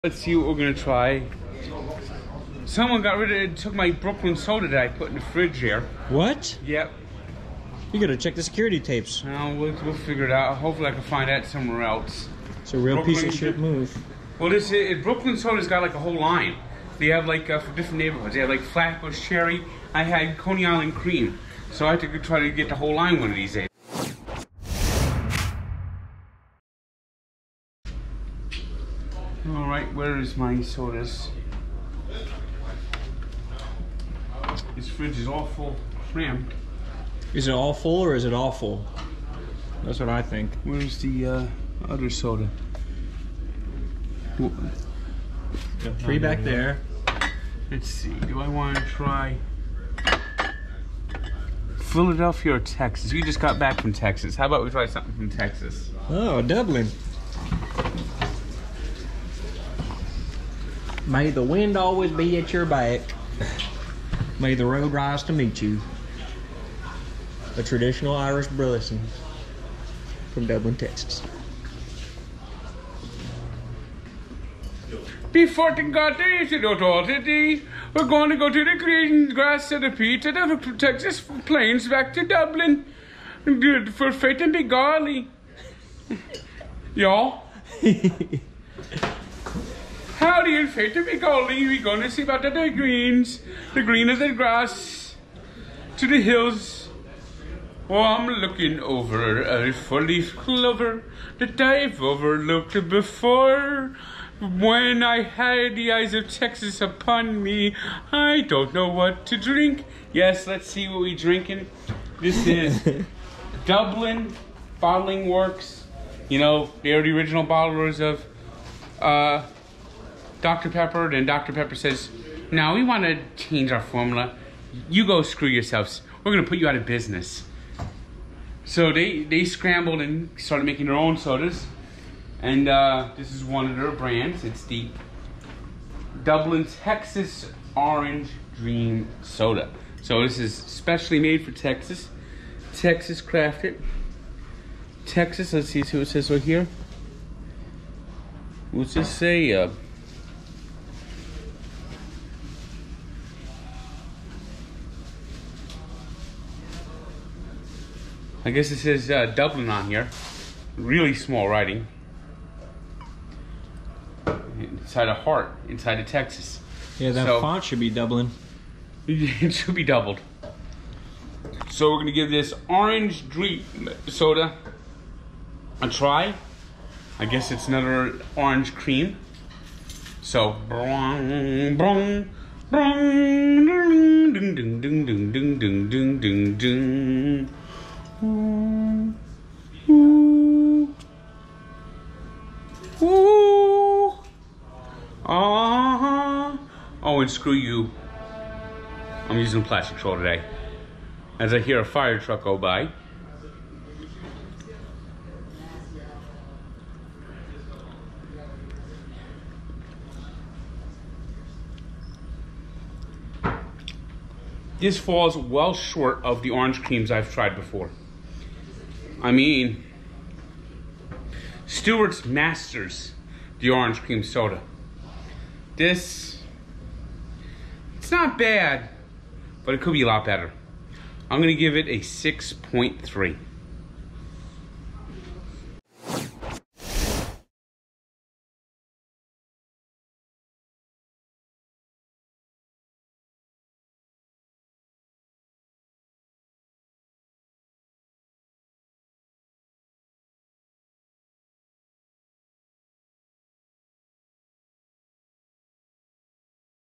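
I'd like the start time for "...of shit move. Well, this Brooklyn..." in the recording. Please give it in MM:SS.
00:13.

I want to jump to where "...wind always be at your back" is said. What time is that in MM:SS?
01:01.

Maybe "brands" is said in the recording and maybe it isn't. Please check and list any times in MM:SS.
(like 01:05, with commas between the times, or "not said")
02:13.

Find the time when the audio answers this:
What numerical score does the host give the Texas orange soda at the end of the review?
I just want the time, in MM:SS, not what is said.
03:51.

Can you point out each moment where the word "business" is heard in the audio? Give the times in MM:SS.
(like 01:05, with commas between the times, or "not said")
02:06.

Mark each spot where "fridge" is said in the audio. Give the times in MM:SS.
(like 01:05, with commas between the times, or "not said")
00:05, 00:34.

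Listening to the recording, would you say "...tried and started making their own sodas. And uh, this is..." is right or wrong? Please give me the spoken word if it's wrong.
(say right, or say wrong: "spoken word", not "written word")
wrong: "scrambled", not "tried".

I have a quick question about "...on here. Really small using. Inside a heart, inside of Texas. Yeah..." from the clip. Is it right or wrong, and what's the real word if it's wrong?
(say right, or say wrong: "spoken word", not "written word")
wrong: "writing", not "using".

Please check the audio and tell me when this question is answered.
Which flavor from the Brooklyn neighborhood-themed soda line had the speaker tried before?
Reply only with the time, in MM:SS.
00:20.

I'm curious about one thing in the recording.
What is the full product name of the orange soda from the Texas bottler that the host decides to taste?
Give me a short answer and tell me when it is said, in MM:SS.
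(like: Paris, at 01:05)
Orange Dream Soda, at 02:17.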